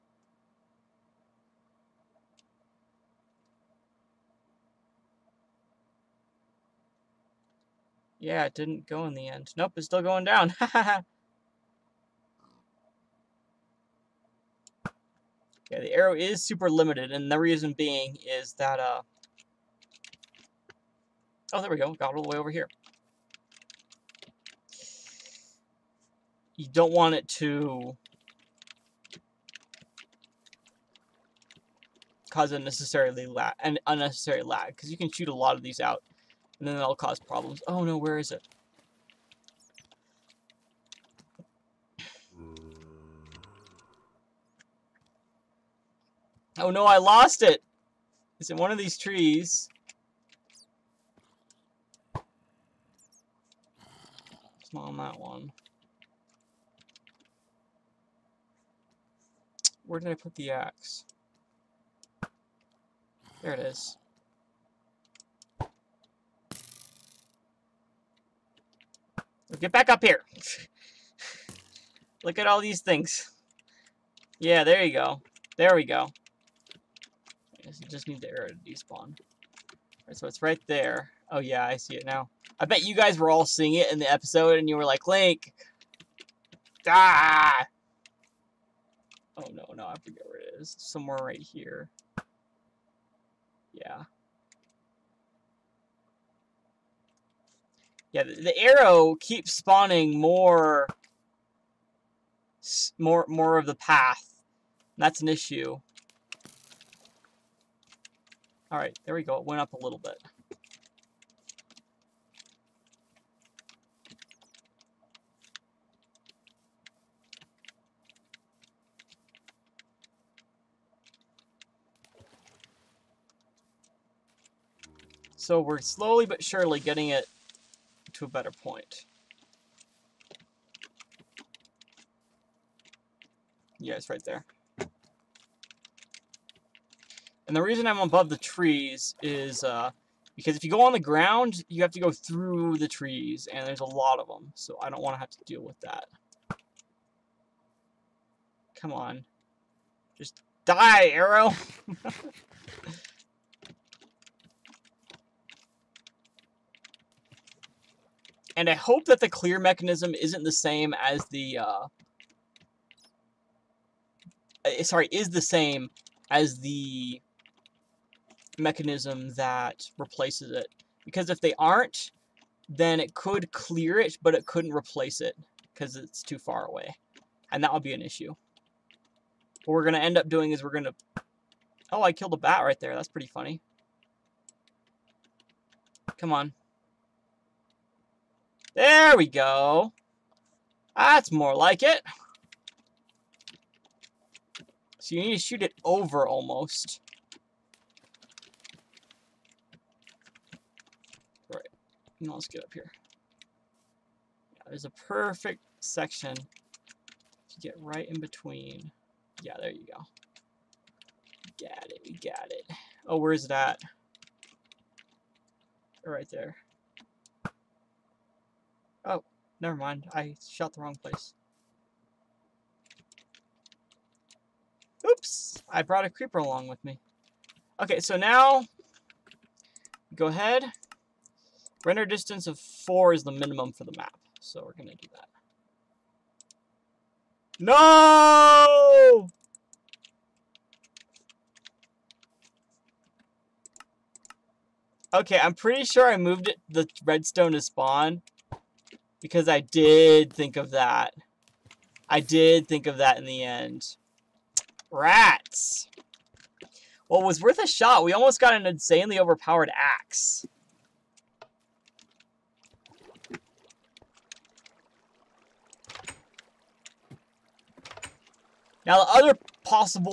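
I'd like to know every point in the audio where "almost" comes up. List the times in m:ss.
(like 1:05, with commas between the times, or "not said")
3:16, 4:18.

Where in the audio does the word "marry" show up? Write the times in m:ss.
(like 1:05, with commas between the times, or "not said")
not said.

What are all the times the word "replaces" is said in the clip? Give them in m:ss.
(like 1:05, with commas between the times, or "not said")
2:49, 2:54.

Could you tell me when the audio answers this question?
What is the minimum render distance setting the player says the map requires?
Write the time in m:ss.
3:52.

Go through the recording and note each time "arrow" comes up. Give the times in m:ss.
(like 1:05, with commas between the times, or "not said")
0:15, 1:18, 1:38, 2:31.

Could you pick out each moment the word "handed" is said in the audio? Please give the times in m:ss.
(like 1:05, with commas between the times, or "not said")
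not said.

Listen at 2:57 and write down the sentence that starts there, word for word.
And that would be an issue.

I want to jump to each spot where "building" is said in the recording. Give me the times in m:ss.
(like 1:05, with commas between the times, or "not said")
not said.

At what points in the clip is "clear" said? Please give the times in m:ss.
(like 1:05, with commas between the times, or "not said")
2:39, 2:53.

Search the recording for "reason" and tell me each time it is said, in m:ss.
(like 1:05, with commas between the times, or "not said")
0:17, 2:17.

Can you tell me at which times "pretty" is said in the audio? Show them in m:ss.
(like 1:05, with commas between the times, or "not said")
3:03, 4:05.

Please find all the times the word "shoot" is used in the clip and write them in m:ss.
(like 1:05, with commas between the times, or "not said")
0:35, 3:15.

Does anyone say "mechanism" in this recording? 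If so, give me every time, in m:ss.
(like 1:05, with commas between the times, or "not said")
2:39, 2:48.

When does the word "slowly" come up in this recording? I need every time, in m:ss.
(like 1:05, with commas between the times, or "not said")
2:05.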